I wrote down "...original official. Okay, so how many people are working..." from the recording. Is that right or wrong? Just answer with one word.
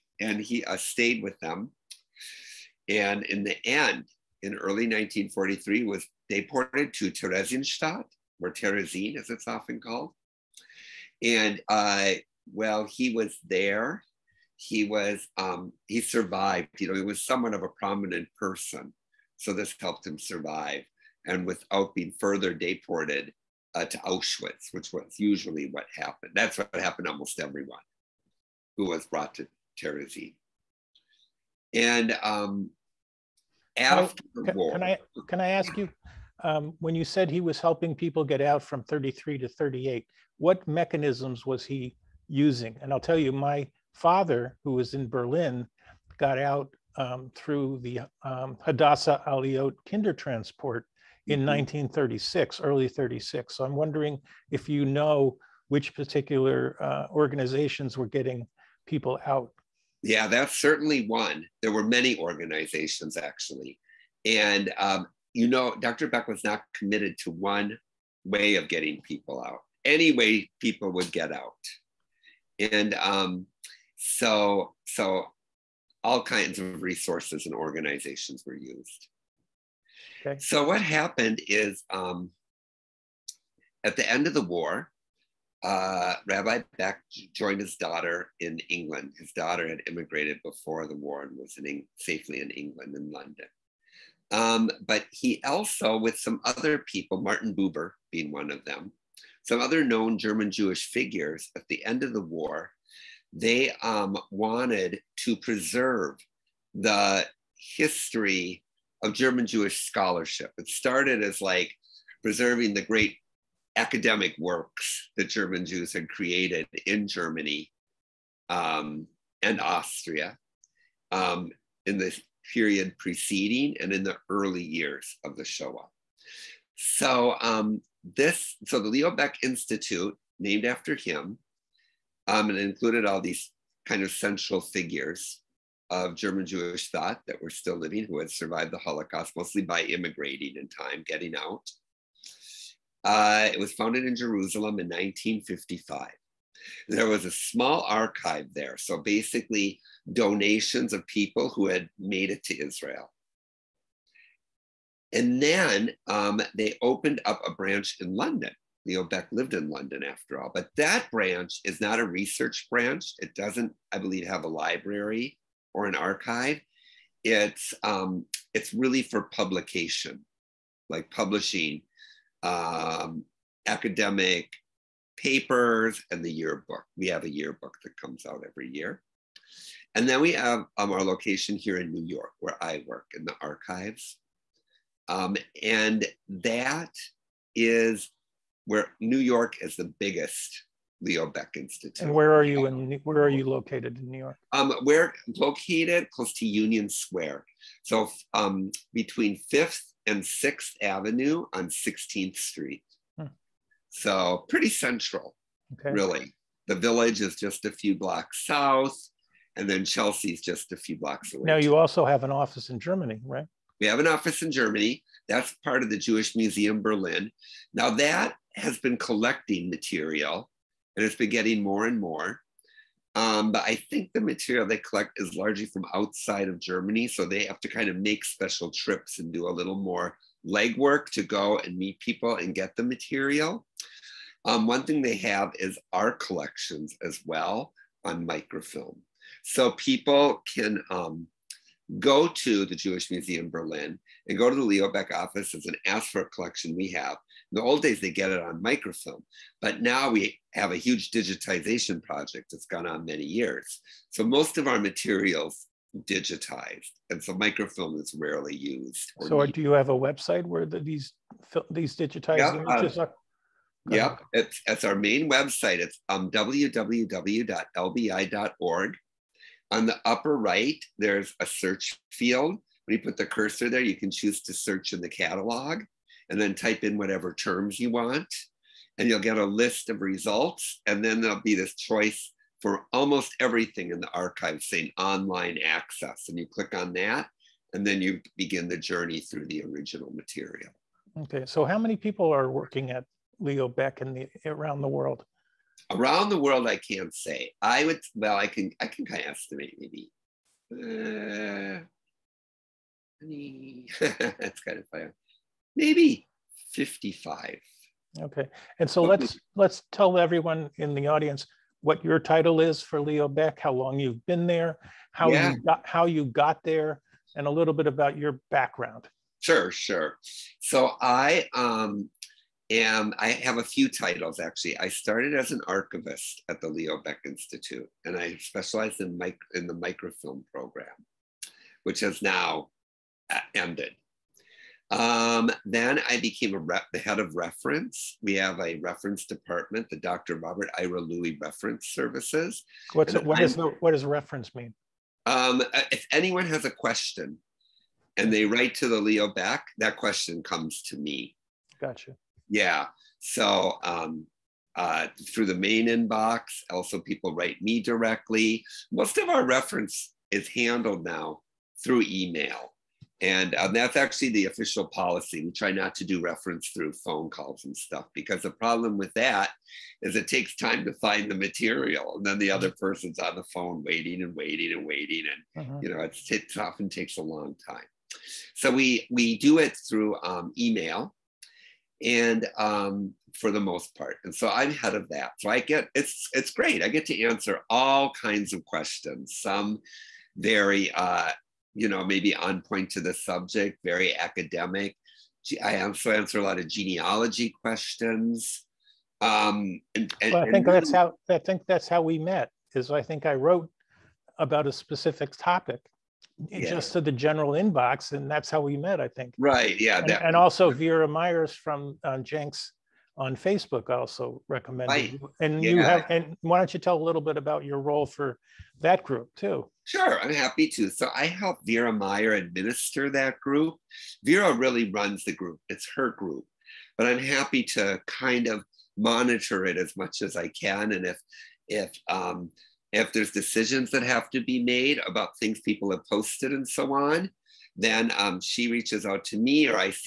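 wrong.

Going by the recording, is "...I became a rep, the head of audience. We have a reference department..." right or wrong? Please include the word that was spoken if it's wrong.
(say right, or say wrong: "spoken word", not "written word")
wrong: "reference", not "audience".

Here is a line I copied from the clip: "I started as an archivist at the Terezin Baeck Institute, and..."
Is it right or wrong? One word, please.
wrong.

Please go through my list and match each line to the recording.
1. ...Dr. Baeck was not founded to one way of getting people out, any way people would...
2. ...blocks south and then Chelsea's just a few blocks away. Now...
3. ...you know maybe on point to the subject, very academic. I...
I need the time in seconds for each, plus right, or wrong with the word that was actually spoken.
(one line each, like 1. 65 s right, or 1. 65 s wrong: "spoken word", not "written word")
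1. 65 s wrong: "committed", not "founded"
2. 207 s right
3. 391 s right.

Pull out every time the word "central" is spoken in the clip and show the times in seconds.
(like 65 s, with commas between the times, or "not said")
134 s, 204 s.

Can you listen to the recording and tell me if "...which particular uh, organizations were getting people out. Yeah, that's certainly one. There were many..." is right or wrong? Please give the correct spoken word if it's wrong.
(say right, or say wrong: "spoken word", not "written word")
right.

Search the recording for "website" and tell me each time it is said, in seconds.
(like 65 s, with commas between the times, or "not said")
259 s, 265 s.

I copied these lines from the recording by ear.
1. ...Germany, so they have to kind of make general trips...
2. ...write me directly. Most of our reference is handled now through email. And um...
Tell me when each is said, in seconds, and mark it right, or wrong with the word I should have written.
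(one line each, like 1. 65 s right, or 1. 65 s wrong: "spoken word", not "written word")
1. 226 s wrong: "special", not "general"
2. 357 s right.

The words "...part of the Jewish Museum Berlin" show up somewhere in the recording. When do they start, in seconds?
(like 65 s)
215 s.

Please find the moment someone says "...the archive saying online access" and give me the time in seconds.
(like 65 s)
283 s.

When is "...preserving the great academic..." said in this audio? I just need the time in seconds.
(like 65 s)
112 s.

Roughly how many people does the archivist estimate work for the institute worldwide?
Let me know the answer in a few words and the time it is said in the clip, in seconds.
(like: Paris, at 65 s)
55, at 306 s.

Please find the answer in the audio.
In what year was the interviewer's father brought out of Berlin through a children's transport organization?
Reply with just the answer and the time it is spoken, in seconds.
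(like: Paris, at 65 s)
1936, at 51 s.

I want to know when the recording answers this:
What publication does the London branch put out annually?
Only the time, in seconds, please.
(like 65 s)
176 s.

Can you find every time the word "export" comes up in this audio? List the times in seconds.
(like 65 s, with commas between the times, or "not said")
not said.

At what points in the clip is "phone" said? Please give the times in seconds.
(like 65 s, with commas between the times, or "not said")
366 s, 373 s.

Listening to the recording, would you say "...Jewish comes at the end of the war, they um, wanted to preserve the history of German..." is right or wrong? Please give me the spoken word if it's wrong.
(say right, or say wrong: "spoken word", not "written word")
wrong: "figures", not "comes".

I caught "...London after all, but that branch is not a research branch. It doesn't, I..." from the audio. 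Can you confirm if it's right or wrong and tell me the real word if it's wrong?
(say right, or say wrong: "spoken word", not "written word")
right.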